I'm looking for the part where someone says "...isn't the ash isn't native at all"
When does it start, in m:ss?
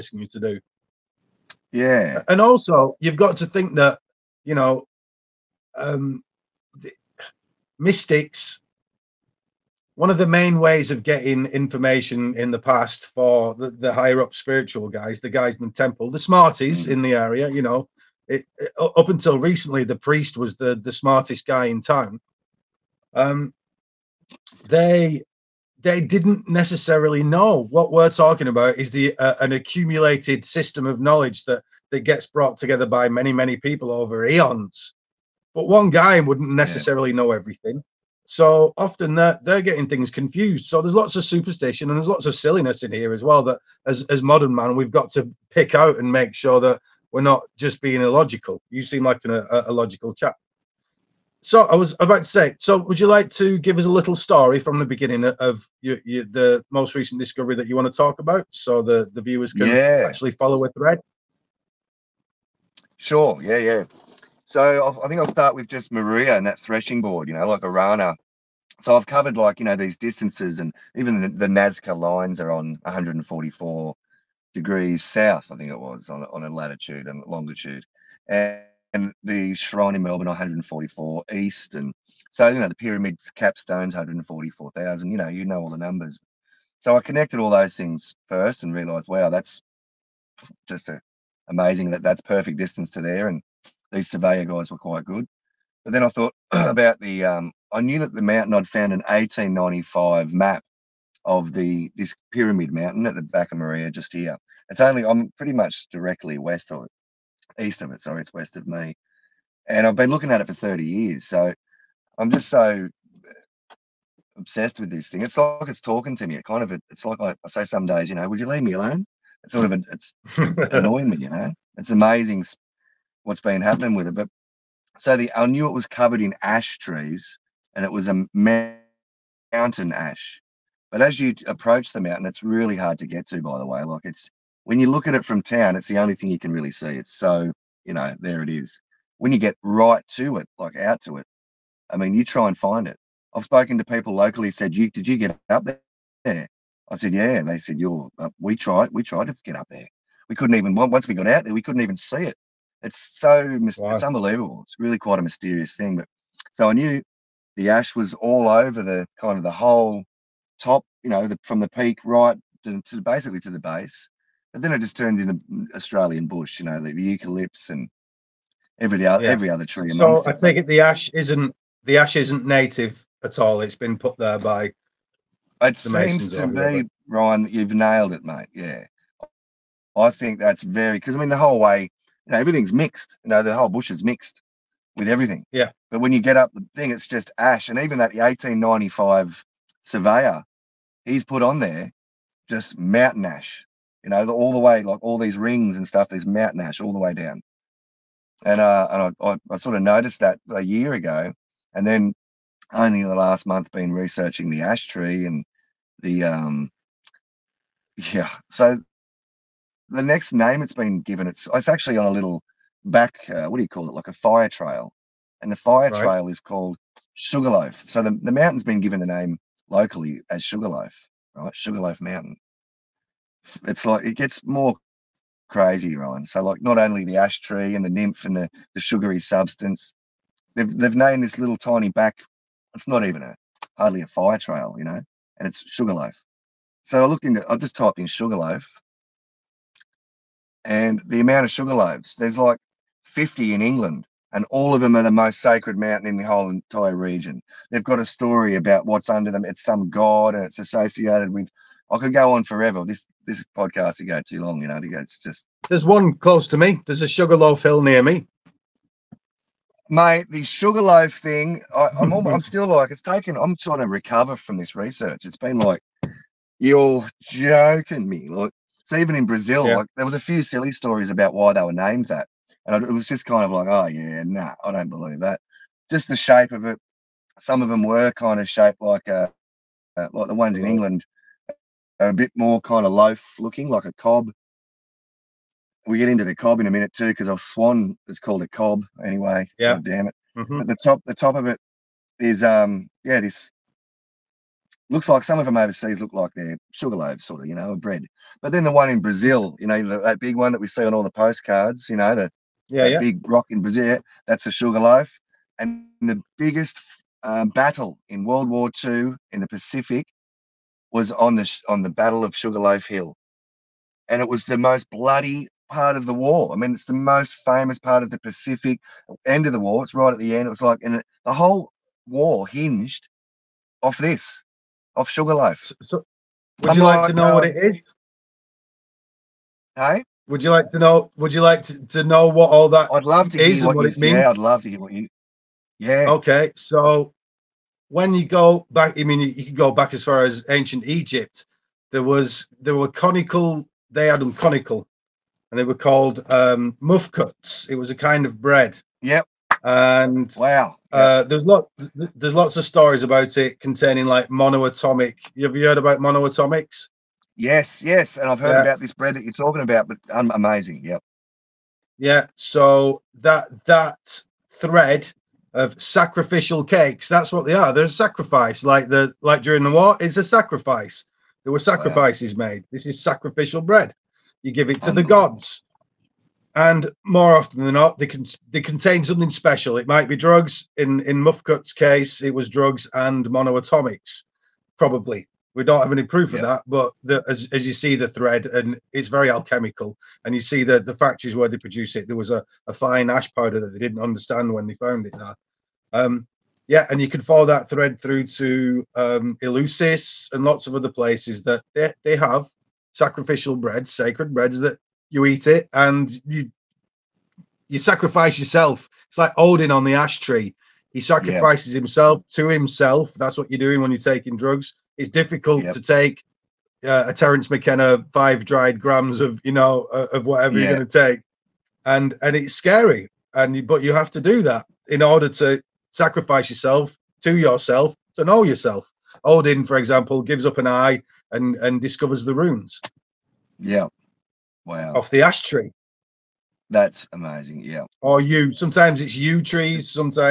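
2:51.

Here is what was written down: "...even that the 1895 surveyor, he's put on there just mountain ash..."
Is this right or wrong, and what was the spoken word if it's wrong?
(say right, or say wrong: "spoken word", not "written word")
right.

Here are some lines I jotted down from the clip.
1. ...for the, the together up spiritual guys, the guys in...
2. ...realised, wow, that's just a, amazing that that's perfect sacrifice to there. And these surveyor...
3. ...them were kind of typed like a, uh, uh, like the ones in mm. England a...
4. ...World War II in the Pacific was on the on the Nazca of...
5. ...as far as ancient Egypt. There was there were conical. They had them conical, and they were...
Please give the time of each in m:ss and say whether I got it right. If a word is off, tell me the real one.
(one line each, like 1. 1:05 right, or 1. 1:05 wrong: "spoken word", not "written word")
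1. 0:13 wrong: "higher", not "together"
2. 1:28 wrong: "distance", not "sacrifice"
3. 4:37 wrong: "shaped", not "typed"
4. 5:08 wrong: "Battle", not "Nazca"
5. 5:39 right.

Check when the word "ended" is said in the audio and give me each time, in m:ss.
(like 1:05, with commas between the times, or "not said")
not said.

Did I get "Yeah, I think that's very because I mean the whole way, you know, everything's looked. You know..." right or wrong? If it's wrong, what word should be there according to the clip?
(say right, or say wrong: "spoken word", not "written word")
wrong: "mixed", not "looked".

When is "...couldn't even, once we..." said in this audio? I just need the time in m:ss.
2:30.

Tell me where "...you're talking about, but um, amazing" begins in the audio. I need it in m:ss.
5:59.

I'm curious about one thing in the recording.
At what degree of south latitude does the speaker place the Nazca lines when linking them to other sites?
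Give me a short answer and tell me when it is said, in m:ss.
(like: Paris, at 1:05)
144, at 1:12.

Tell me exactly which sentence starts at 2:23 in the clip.
I've spoken to people locally said, you, did you get up there?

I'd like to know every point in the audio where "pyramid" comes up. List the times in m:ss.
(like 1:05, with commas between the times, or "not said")
1:22, 1:42.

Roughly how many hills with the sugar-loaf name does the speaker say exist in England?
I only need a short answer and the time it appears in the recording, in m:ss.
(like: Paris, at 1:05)
50, at 4:03.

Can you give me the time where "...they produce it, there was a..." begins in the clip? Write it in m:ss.
6:31.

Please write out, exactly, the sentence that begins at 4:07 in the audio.
They've got a story about what's under them.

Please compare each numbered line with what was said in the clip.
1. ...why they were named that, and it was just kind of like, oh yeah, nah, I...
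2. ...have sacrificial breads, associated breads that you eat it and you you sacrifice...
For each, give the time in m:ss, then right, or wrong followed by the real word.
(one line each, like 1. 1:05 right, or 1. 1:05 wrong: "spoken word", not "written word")
1. 4:31 right
2. 6:42 wrong: "sacred", not "associated".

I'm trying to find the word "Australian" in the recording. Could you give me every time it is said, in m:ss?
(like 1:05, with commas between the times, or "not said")
2:45.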